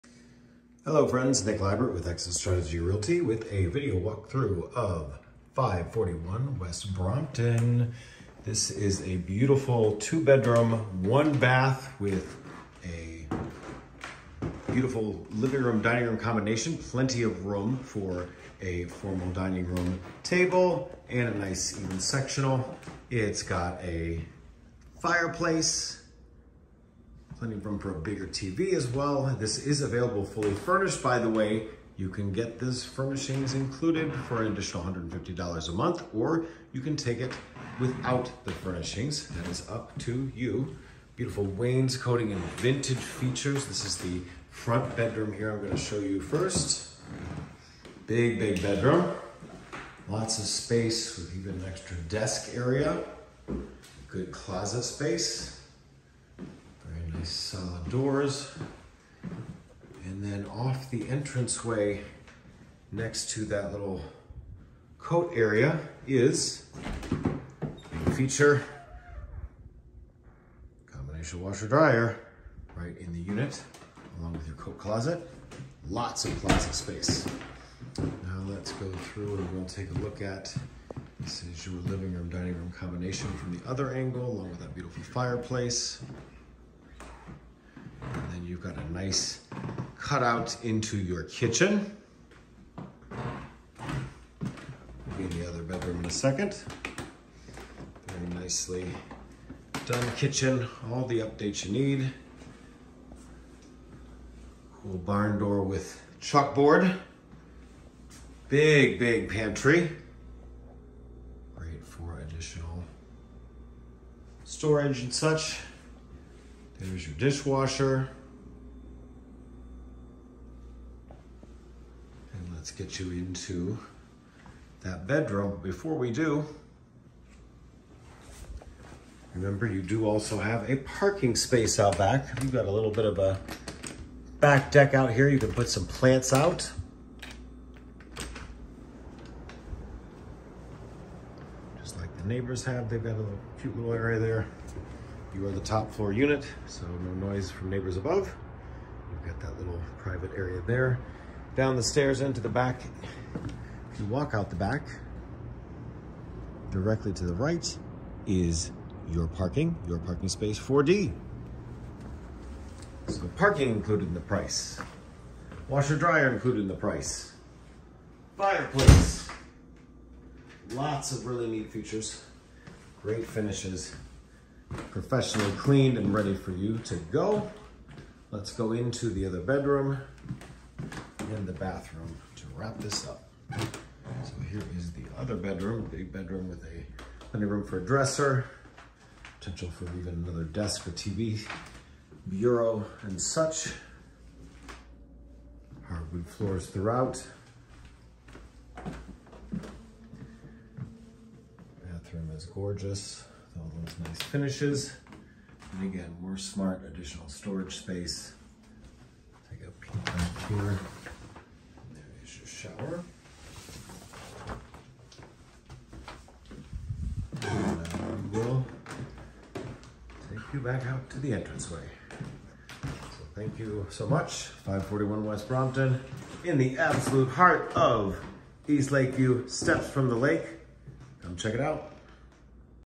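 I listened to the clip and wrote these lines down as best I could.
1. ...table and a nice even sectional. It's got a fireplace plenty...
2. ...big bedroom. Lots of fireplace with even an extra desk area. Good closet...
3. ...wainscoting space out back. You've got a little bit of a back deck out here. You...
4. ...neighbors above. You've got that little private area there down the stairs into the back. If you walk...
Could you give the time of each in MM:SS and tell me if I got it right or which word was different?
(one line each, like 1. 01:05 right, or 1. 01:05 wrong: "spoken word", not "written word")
1. 00:20 right
2. 00:48 wrong: "space", not "fireplace"
3. 02:10 wrong: "parking", not "wainscoting"
4. 02:27 right.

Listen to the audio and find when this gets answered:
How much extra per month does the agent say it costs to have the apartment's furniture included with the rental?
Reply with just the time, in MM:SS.
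00:34.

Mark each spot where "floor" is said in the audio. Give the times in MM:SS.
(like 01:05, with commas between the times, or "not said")
02:25, 03:16.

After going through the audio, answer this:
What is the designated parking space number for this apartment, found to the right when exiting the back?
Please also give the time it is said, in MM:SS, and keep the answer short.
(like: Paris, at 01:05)
4D, at 02:40.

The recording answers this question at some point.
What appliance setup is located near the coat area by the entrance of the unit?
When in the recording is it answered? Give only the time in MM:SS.
01:10.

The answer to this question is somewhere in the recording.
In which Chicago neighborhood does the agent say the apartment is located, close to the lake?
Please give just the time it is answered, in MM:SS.
03:48.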